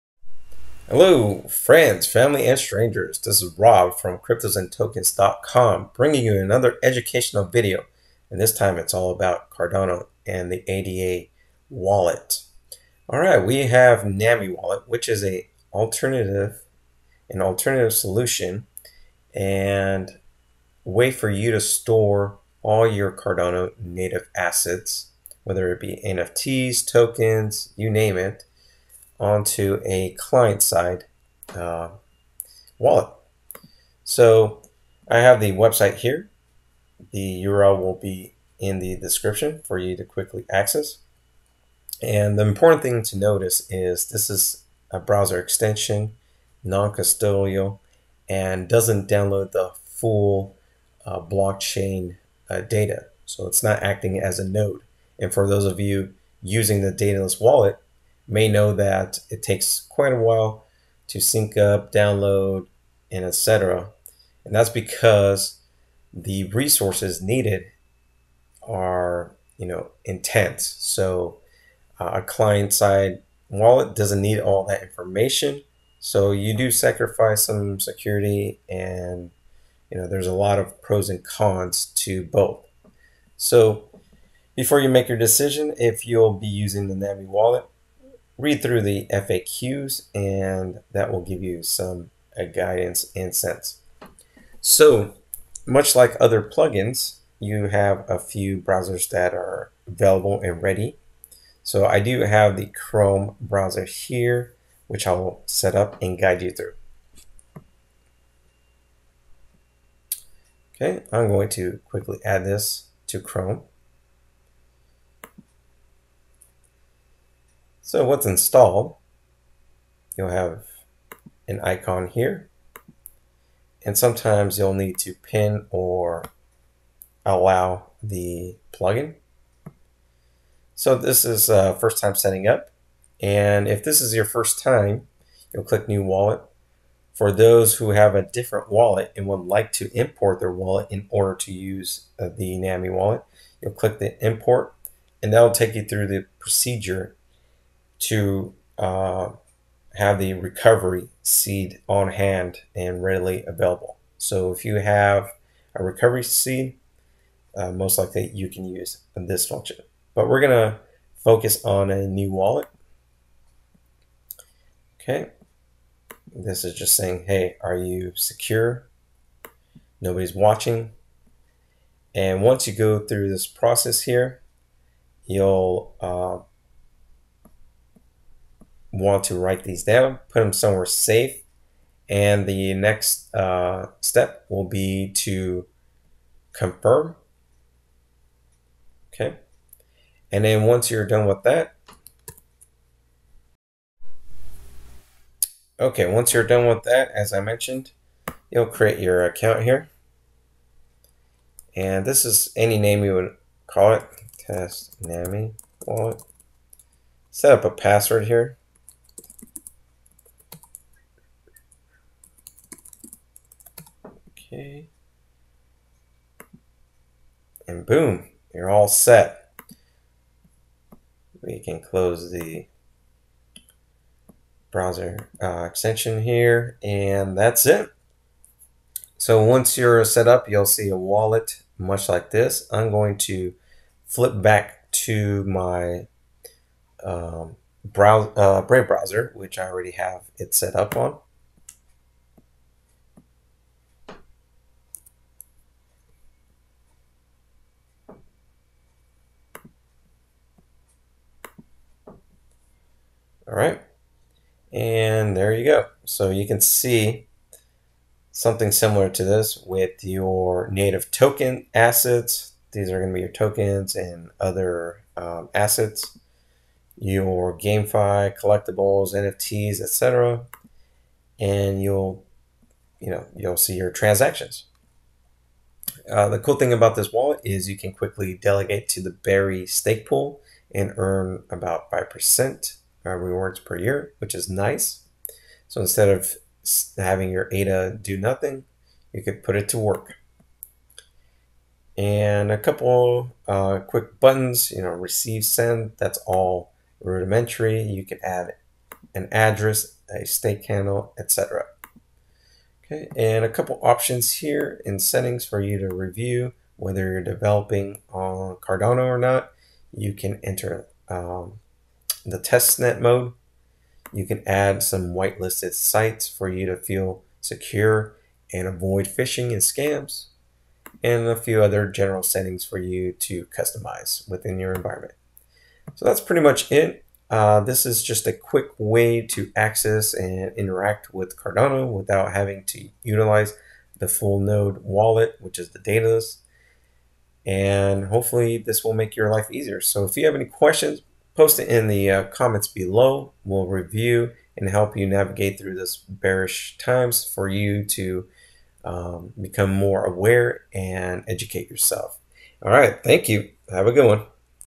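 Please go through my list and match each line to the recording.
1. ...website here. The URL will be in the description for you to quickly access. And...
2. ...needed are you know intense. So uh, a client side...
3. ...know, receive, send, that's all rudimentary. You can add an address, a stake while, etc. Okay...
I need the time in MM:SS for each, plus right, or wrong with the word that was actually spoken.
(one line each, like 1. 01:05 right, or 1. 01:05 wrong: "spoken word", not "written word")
1. 00:35 right
2. 01:07 right
3. 04:54 wrong: "handle", not "while".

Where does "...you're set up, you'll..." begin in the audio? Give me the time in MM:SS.
03:49.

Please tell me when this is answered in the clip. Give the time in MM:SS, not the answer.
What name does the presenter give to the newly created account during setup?
03:24.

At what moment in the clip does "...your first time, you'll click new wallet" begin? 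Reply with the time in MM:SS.
02:14.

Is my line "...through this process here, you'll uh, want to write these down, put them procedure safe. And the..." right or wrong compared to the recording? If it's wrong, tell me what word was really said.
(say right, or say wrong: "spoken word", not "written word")
wrong: "somewhere", not "procedure".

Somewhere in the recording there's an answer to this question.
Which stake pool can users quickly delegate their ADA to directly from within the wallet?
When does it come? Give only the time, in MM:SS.
04:39.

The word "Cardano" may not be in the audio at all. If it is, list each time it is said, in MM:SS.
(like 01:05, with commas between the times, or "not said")
00:09, 00:23, 05:08, 05:31.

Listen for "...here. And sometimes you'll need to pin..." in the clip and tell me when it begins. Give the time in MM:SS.
02:02.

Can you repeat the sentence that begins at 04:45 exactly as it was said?
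So instead of having your ADA do nothing, you could put it to work.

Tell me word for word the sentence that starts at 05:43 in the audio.
We'll review and help you navigate through this bearish times for you to um, become more aware and educate yourself.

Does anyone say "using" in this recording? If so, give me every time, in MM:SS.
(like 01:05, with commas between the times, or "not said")
00:56, 01:26.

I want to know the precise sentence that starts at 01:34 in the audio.
So much like other plugins, you have a few browsers that are available and ready.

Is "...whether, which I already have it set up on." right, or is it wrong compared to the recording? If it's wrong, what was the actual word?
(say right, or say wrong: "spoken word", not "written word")
wrong: "browser", not "whether".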